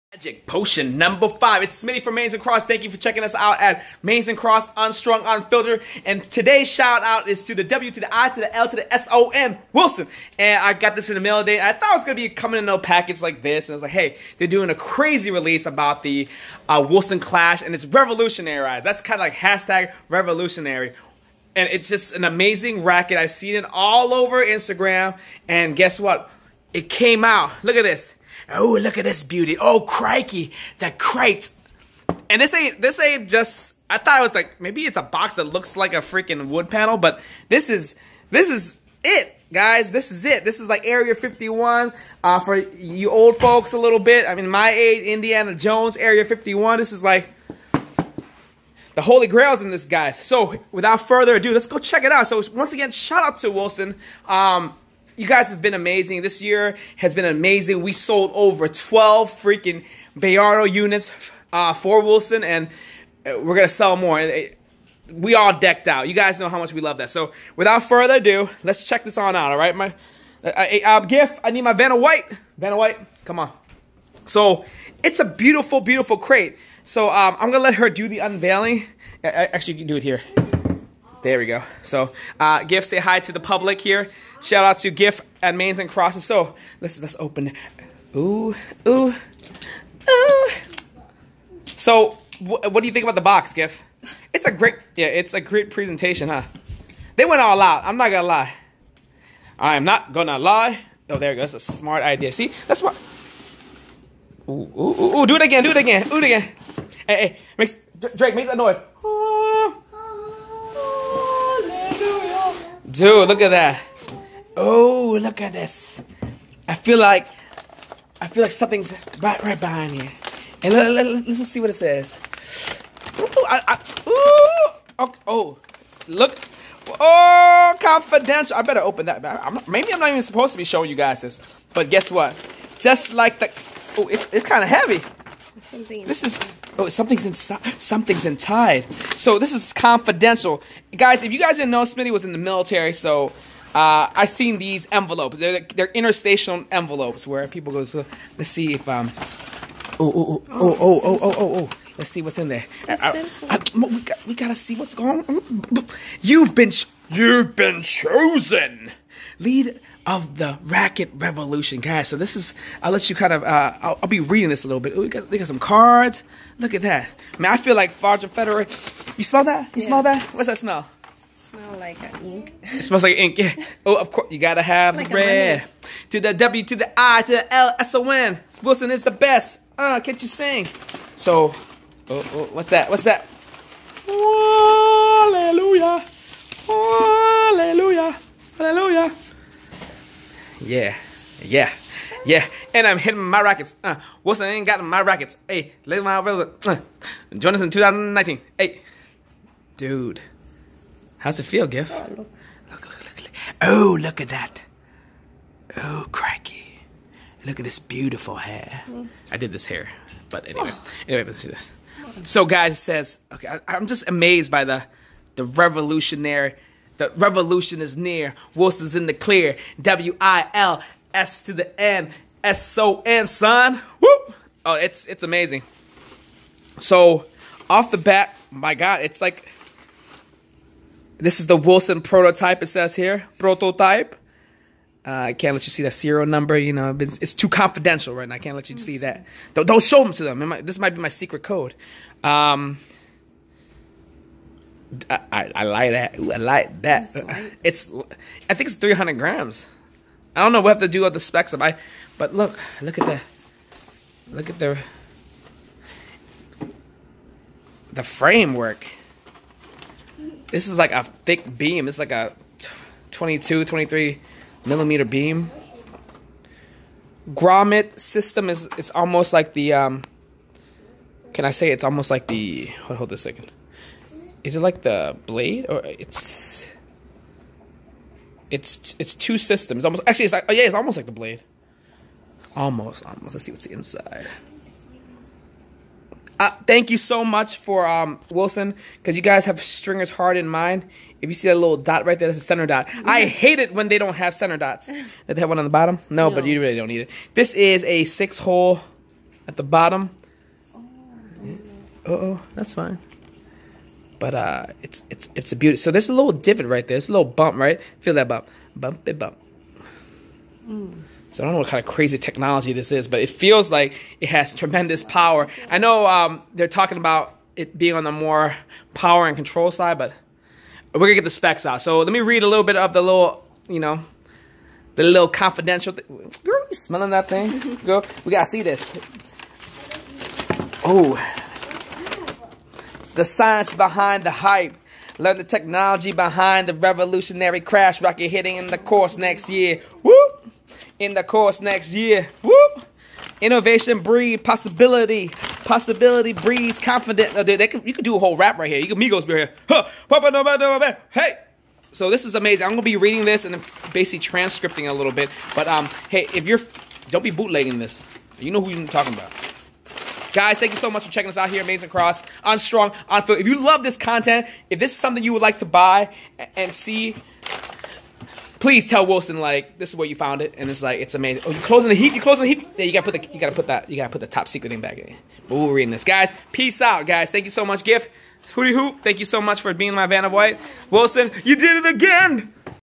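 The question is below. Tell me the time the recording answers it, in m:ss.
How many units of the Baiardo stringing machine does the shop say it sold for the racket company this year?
0:58.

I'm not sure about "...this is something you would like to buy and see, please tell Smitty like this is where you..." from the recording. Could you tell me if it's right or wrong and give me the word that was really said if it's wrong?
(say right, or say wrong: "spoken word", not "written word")
wrong: "Wilson", not "Smitty".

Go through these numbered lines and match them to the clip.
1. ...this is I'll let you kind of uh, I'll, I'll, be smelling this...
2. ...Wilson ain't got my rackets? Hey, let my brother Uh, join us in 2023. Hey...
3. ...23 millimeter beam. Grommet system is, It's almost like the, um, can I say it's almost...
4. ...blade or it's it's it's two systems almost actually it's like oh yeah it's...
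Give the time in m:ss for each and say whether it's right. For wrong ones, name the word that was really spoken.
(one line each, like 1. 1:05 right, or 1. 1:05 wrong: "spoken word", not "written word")
1. 2:42 wrong: "reading", not "smelling"
2. 3:14 wrong: "2019", not "2023"
3. 4:23 right
4. 4:35 right.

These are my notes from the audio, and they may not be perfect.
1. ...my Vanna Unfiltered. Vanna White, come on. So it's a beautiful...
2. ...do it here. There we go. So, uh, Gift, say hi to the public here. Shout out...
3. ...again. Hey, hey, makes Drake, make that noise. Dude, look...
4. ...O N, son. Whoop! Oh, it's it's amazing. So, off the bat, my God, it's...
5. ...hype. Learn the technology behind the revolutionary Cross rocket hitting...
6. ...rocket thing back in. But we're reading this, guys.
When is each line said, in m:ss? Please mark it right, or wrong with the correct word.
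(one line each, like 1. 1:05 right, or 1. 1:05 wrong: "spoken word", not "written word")
1. 1:11 wrong: "White", not "Unfiltered"
2. 1:19 right
3. 1:46 right
4. 3:42 right
5. 5:34 wrong: "Clash", not "Cross"
6. 6:14 wrong: "secret", not "rocket".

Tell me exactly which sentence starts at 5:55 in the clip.
But um, hey, if you're, don't be bootlegging this.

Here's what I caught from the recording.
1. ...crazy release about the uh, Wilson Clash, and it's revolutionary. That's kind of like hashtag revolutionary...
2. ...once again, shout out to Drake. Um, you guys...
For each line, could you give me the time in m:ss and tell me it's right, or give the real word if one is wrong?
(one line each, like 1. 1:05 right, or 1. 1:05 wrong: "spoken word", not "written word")
1. 0:14 right
2. 0:52 wrong: "Wilson", not "Drake".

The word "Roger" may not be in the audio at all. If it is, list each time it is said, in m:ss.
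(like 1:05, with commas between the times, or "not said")
2:48.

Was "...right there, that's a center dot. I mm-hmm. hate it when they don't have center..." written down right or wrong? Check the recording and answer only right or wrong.
right.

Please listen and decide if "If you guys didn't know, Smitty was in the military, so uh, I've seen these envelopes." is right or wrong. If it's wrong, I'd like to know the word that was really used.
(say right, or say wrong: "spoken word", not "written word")
right.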